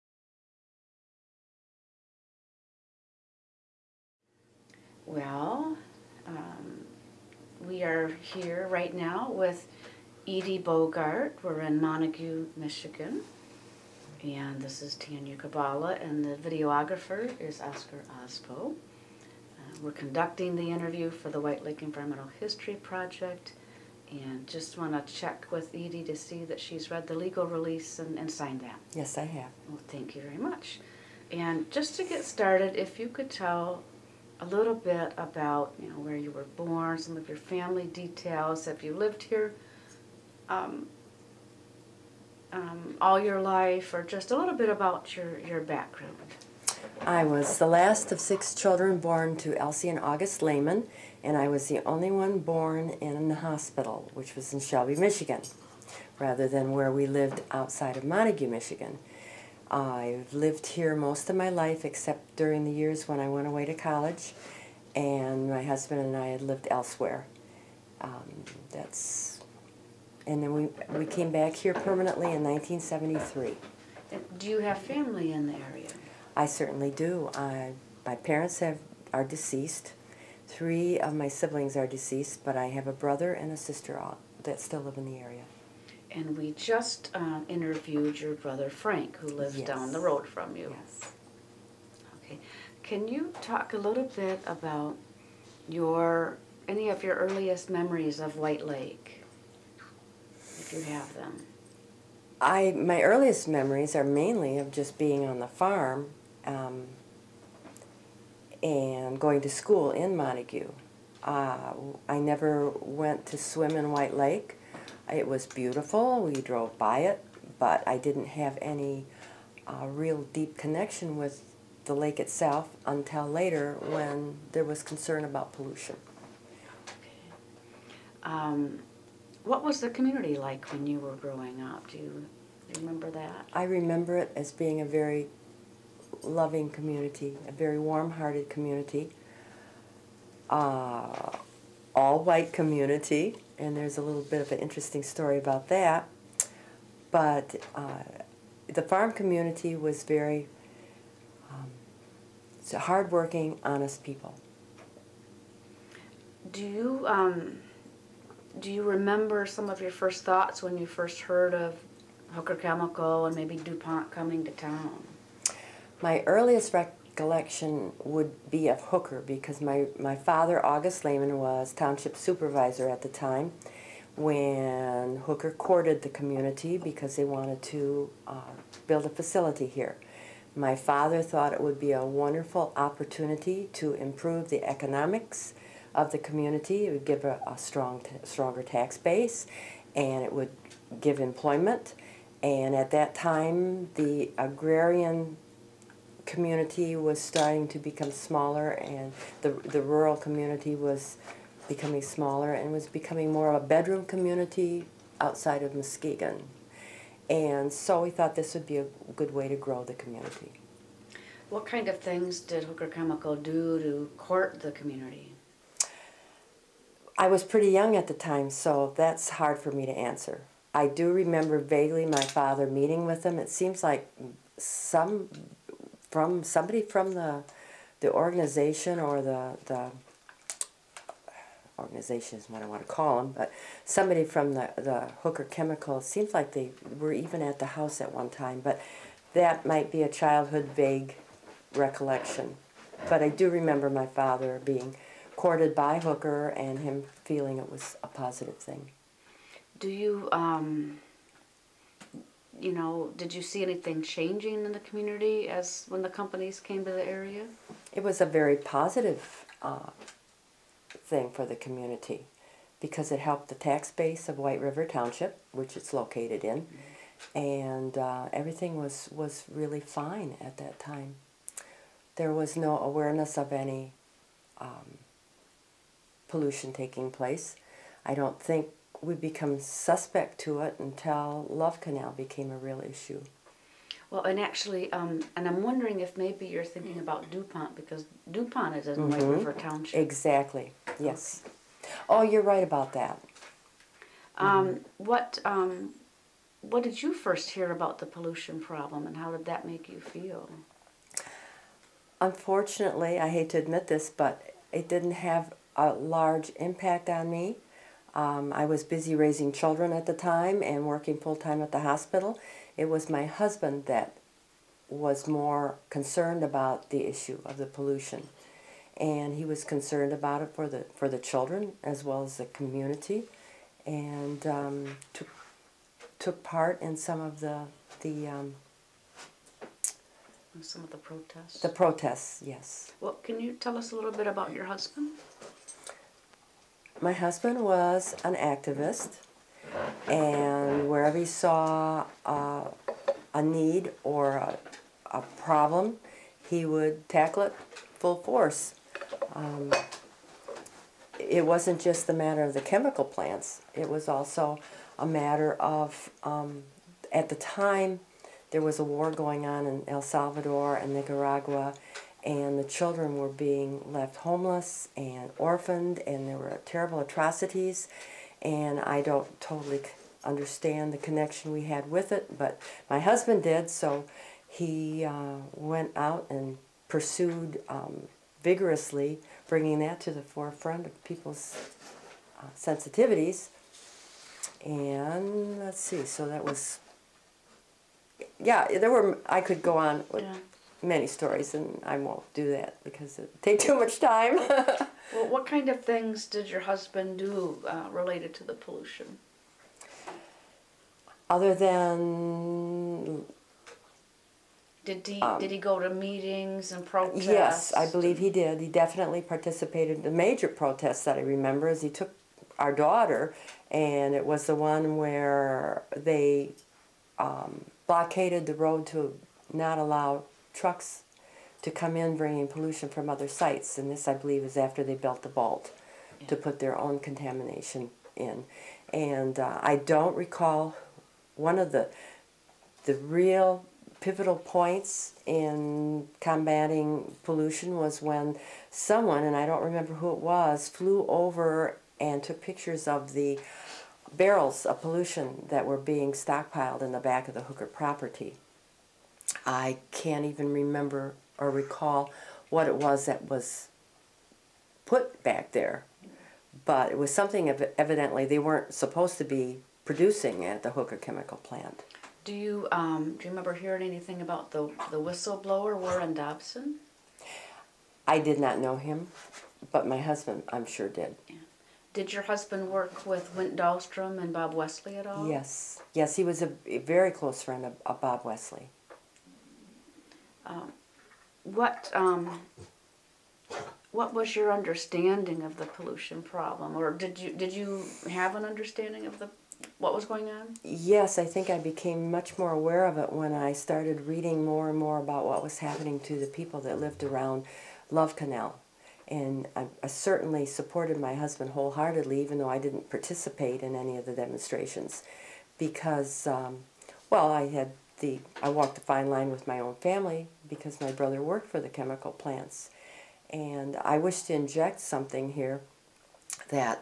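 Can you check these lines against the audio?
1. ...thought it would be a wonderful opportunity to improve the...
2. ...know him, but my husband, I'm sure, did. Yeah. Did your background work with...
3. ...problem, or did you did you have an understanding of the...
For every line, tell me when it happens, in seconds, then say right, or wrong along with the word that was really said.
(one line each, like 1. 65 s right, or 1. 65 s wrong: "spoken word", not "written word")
1. 181 s right
2. 468 s wrong: "husband", not "background"
3. 486 s right.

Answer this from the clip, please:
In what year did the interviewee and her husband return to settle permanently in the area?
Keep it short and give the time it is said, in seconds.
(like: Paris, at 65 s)
1973, at 72 s.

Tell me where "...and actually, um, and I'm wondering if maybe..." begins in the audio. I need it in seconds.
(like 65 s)
284 s.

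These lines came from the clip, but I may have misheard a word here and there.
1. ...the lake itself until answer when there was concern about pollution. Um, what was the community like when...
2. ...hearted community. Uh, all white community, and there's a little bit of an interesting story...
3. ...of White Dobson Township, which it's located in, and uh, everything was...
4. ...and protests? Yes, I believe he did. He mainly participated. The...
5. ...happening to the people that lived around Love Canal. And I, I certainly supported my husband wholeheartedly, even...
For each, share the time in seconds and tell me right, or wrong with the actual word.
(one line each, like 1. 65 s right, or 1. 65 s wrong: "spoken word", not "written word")
1. 121 s wrong: "later", not "answer"
2. 138 s right
3. 264 s wrong: "River", not "Dobson"
4. 406 s wrong: "definitely", not "mainly"
5. 495 s right.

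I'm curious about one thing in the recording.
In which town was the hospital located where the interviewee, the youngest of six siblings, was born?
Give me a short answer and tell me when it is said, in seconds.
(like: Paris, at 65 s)
Shelby, Michigan, at 54 s.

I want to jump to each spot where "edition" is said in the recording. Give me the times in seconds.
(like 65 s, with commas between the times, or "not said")
not said.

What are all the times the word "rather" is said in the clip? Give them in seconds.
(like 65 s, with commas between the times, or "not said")
56 s.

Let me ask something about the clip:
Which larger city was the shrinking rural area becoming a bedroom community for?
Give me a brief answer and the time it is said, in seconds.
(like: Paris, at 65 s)
Muskegon, at 205 s.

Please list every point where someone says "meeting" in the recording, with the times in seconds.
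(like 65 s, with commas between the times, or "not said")
222 s, 405 s.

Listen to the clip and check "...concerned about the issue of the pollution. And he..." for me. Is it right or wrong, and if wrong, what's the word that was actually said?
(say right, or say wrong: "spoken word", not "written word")
right.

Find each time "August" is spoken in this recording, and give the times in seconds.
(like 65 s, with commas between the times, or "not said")
49 s, 170 s.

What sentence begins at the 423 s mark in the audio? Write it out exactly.
And this, I believe, is after they built the vault yeah.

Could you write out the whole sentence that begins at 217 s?
I was pretty young at the time, so that's hard for me to answer.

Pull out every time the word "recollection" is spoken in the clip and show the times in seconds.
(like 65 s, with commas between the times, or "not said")
167 s, 241 s.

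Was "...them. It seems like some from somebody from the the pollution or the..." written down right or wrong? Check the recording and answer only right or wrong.
wrong.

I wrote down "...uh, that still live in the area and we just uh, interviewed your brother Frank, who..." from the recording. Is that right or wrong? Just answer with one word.
right.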